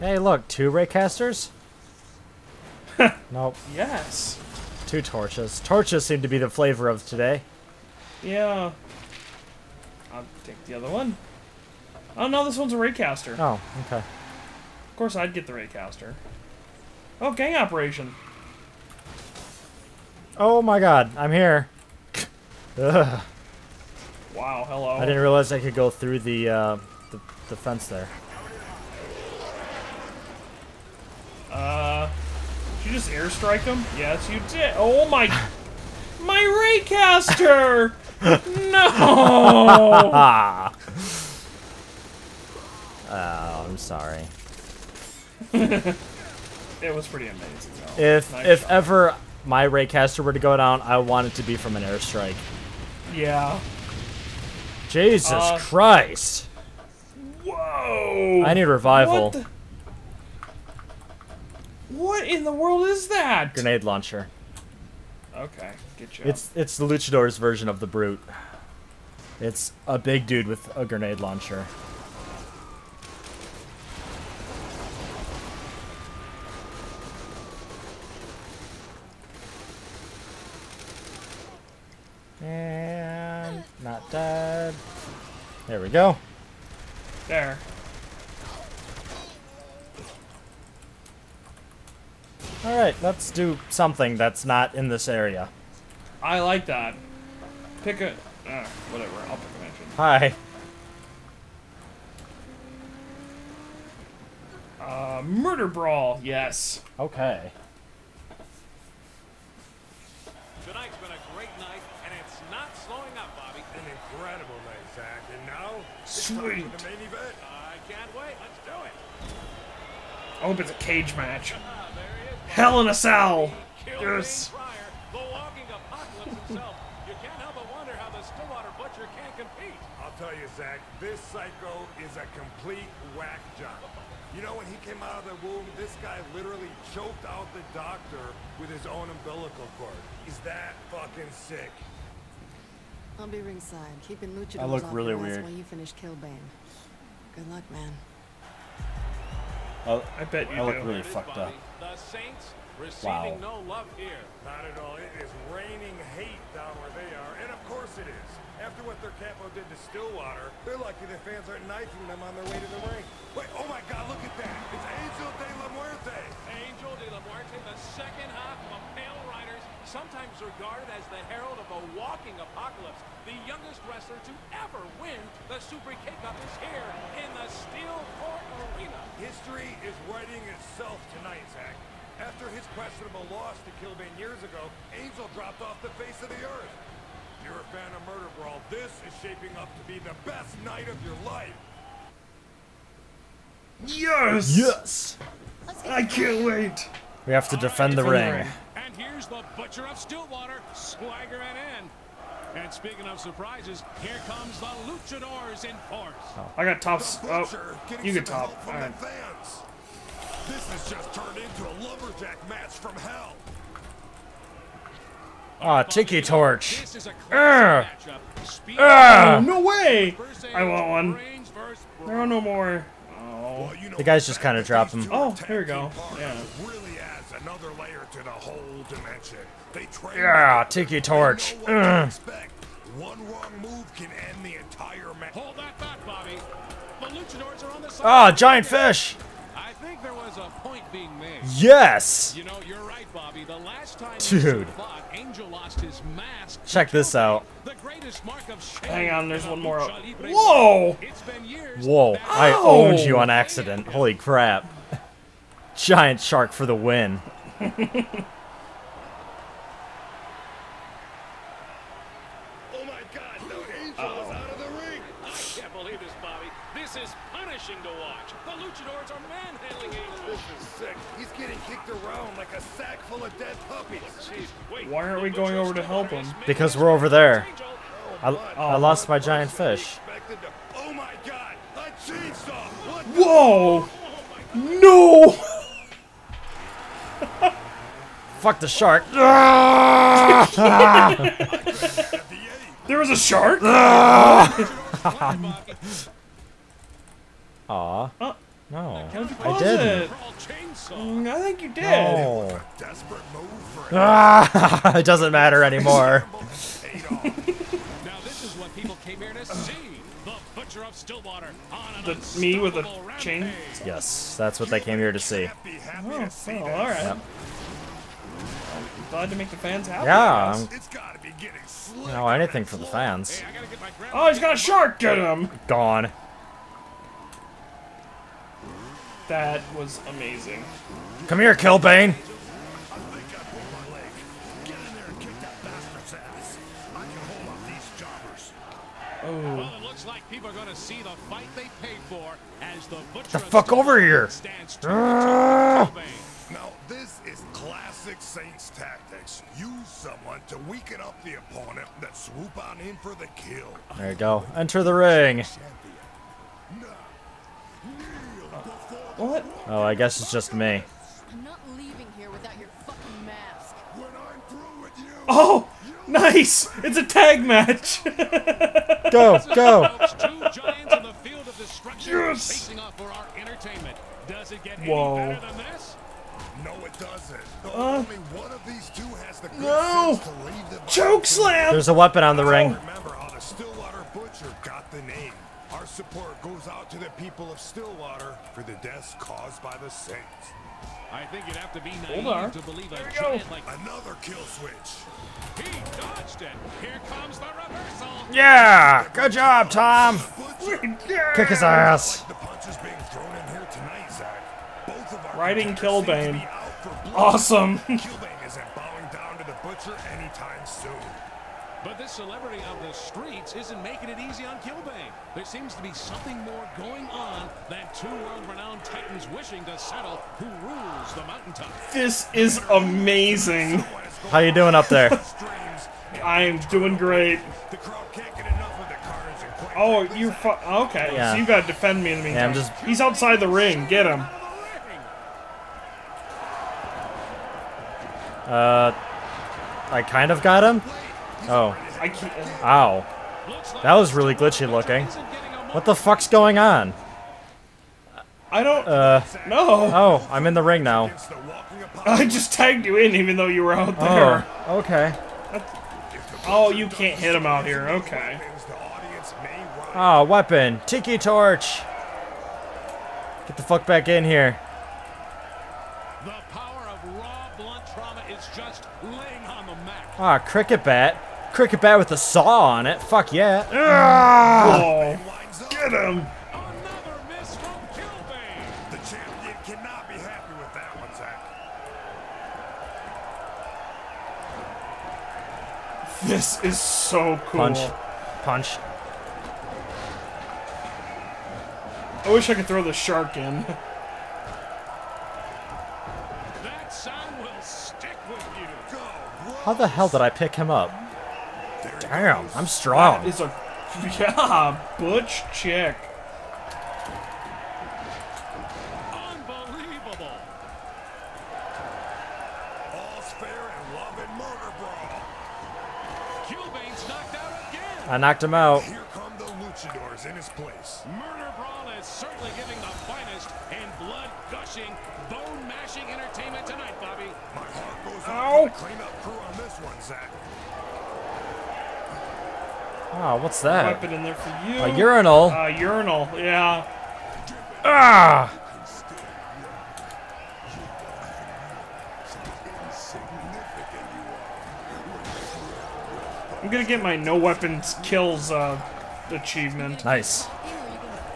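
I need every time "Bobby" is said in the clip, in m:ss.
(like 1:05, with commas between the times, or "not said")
3:56, 4:03, 4:26.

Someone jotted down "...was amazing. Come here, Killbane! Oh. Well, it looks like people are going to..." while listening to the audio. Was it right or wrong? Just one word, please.
right.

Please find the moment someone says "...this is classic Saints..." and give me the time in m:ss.
5:46.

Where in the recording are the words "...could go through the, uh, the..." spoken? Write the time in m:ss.
0:25.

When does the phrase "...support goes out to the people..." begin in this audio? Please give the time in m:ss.
6:25.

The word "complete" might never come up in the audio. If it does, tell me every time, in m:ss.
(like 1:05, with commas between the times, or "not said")
2:12.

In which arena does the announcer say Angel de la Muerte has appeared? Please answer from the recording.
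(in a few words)
Steel Court Arena.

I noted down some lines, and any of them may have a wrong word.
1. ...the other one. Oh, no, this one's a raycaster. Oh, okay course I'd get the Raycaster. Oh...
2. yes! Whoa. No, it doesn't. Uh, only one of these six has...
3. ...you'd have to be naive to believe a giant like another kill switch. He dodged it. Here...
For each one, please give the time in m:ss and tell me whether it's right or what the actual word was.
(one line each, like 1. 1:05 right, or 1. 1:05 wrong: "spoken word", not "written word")
1. 0:10 right
2. 6:12 wrong: "two", not "six"
3. 6:31 right.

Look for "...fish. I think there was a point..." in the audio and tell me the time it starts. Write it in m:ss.
3:58.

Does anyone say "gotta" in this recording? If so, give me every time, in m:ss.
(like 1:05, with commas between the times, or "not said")
5:20, 7:11.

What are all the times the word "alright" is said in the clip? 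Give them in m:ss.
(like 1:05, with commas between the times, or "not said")
1:32, 5:16.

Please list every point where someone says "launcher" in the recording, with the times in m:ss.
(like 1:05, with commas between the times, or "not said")
1:03, 1:11.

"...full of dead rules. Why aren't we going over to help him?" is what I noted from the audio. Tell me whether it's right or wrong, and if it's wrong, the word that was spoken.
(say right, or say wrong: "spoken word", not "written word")
wrong: "puppies", not "rules".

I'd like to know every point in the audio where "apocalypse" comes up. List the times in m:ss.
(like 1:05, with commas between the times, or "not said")
2:52.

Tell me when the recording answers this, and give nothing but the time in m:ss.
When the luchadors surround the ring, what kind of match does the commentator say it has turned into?
3:31.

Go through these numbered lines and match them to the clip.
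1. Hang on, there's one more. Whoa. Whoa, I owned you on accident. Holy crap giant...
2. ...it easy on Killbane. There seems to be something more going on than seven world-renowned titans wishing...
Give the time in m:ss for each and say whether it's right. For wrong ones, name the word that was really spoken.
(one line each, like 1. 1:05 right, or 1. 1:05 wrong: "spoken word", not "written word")
1. 4:08 right
2. 6:54 wrong: "two", not "seven".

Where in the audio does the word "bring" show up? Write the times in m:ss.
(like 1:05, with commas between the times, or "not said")
not said.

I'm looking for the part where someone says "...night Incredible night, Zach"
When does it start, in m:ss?
1:51.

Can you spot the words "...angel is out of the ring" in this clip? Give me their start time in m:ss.
4:23.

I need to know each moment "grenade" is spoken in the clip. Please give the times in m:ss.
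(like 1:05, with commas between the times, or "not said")
1:03, 1:10.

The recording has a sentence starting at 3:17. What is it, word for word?
We have to defend the ring here's the Butcher of Stillwater swaggering in.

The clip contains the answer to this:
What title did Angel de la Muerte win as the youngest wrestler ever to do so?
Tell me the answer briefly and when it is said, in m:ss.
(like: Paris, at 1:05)
Super K-Cup, at 2:55.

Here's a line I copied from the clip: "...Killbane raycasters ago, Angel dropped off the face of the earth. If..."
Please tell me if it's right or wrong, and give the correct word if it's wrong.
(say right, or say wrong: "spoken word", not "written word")
wrong: "years", not "raycasters".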